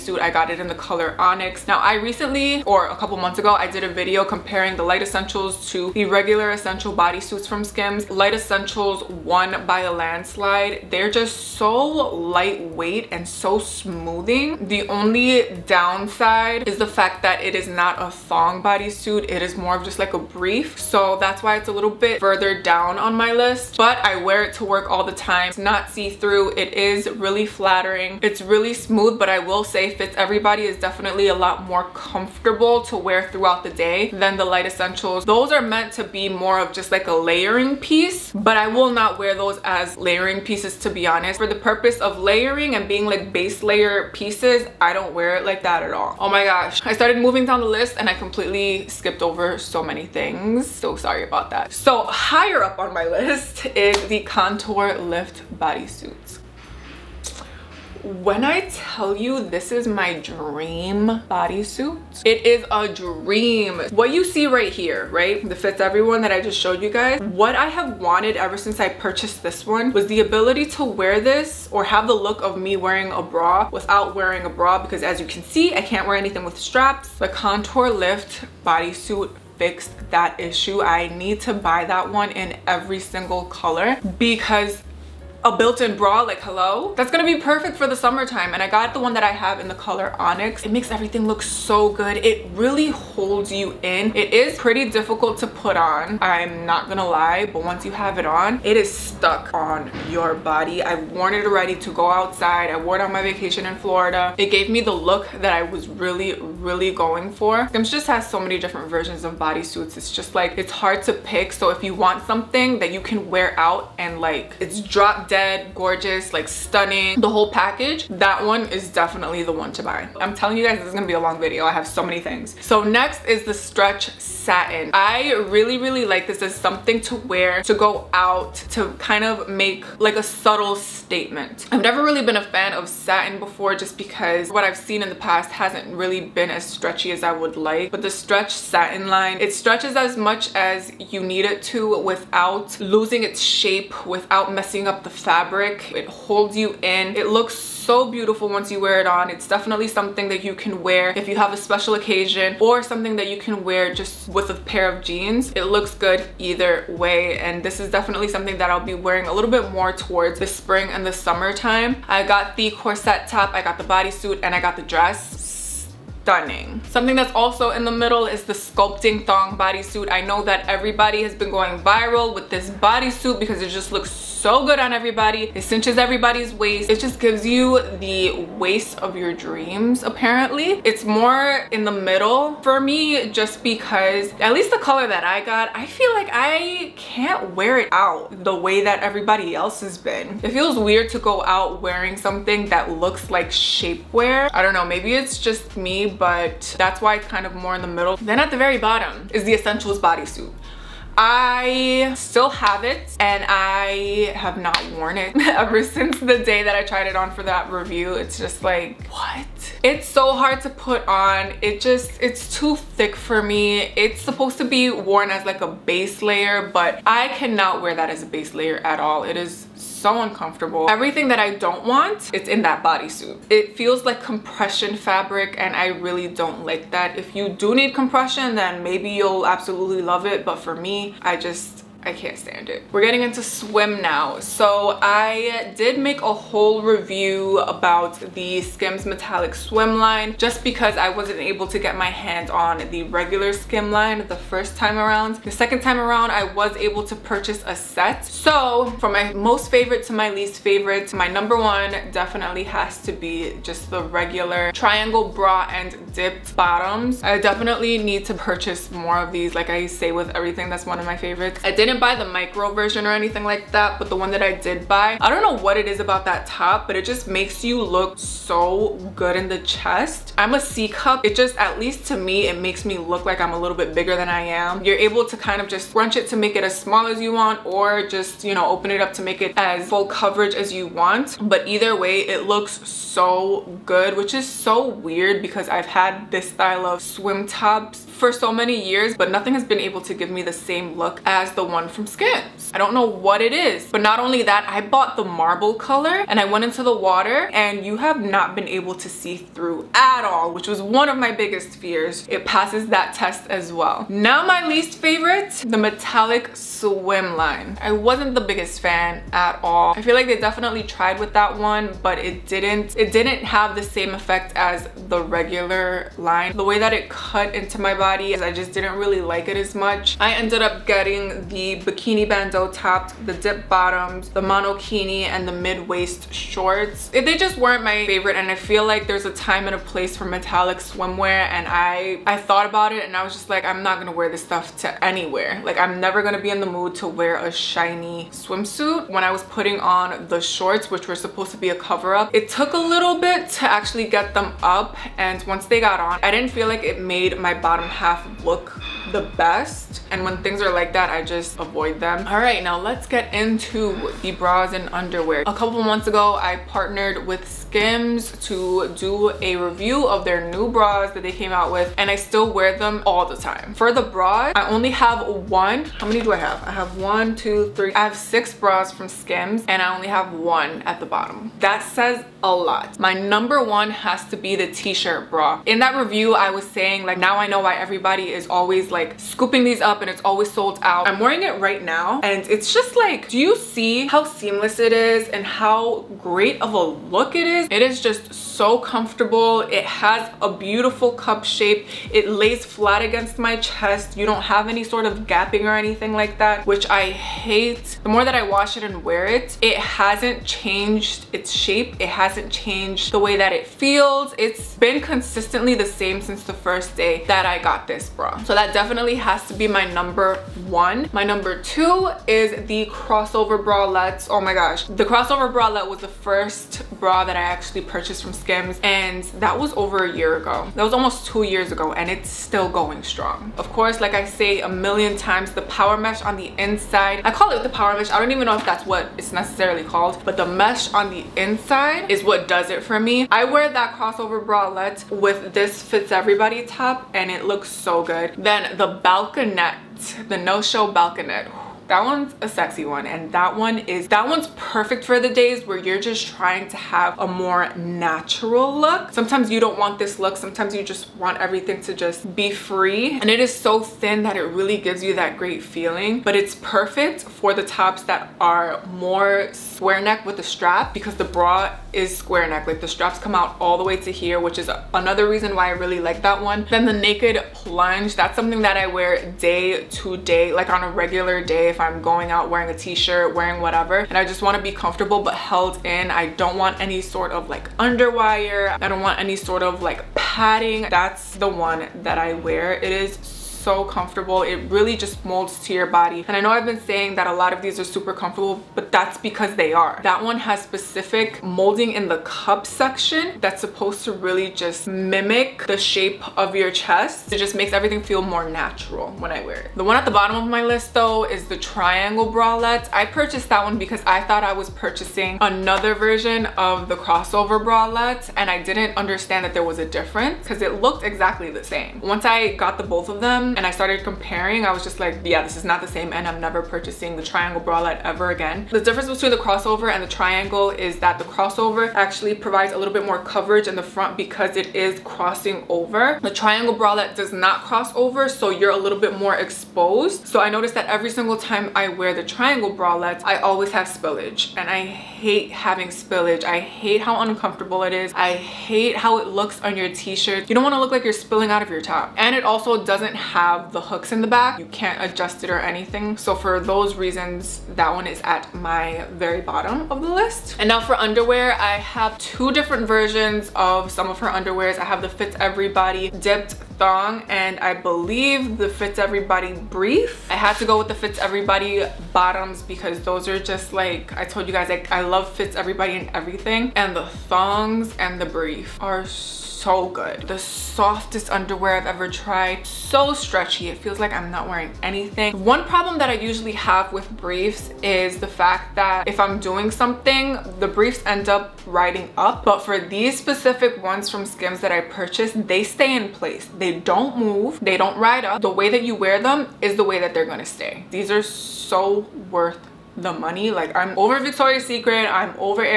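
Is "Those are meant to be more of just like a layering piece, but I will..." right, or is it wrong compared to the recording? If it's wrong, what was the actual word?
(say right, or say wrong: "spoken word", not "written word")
right.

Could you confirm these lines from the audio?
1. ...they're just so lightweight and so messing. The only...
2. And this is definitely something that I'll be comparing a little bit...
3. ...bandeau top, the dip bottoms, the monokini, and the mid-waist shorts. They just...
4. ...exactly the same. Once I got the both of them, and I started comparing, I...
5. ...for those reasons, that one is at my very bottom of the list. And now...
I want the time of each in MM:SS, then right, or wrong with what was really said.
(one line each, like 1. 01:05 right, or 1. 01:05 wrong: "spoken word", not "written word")
1. 00:10 wrong: "smoothing", not "messing"
2. 02:37 wrong: "wearing", not "comparing"
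3. 05:22 right
4. 08:31 right
5. 09:06 right.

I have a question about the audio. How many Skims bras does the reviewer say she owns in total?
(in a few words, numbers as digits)
6.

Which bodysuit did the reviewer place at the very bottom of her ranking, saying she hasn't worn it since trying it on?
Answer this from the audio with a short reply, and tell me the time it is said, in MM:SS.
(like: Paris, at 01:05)
Essentials bodysuit, at 03:19.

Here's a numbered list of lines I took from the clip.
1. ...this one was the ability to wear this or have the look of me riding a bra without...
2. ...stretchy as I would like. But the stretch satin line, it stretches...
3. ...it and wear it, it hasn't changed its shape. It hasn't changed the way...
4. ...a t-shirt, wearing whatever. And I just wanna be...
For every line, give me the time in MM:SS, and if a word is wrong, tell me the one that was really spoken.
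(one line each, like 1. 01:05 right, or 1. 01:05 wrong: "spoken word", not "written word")
1. 01:09 wrong: "wearing", not "riding"
2. 02:16 right
3. 06:38 right
4. 07:52 right.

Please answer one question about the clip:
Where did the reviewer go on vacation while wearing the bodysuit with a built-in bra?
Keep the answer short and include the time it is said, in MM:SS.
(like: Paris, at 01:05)
Florida, at 01:43.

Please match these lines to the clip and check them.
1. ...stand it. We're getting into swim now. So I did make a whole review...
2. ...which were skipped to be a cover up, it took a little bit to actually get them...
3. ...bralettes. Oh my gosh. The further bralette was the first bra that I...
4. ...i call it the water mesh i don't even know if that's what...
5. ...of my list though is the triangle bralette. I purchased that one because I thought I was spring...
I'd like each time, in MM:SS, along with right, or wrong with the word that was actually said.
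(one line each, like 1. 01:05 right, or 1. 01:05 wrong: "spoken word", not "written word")
1. 03:52 right
2. 05:40 wrong: "supposed", not "skipped"
3. 06:53 wrong: "crossover", not "further"
4. 07:07 wrong: "power", not "water"
5. 08:20 wrong: "purchasing", not "spring".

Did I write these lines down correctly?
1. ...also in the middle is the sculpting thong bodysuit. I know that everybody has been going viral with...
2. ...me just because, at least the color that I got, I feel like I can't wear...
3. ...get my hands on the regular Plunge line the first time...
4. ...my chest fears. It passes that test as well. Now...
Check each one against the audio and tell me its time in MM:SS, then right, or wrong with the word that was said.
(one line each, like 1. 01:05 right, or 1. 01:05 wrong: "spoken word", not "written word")
1. 02:47 right
2. 03:02 right
3. 04:01 wrong: "Skim", not "Plunge"
4. 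05:01 wrong: "biggest", not "chest".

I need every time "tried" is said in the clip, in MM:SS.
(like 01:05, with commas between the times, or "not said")
03:26, 05:10, 09:32.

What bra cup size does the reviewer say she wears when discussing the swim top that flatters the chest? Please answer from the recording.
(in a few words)
C cup.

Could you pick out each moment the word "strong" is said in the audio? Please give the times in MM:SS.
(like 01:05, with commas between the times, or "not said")
07:03.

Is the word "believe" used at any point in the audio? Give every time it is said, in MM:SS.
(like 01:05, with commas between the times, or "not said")
09:17.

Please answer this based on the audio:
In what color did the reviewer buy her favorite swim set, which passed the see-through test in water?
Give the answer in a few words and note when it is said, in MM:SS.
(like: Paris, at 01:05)
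Marble, at 04:55.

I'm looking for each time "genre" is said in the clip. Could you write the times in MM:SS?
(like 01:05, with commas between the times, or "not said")
not said.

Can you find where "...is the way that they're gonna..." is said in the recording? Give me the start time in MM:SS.
09:49.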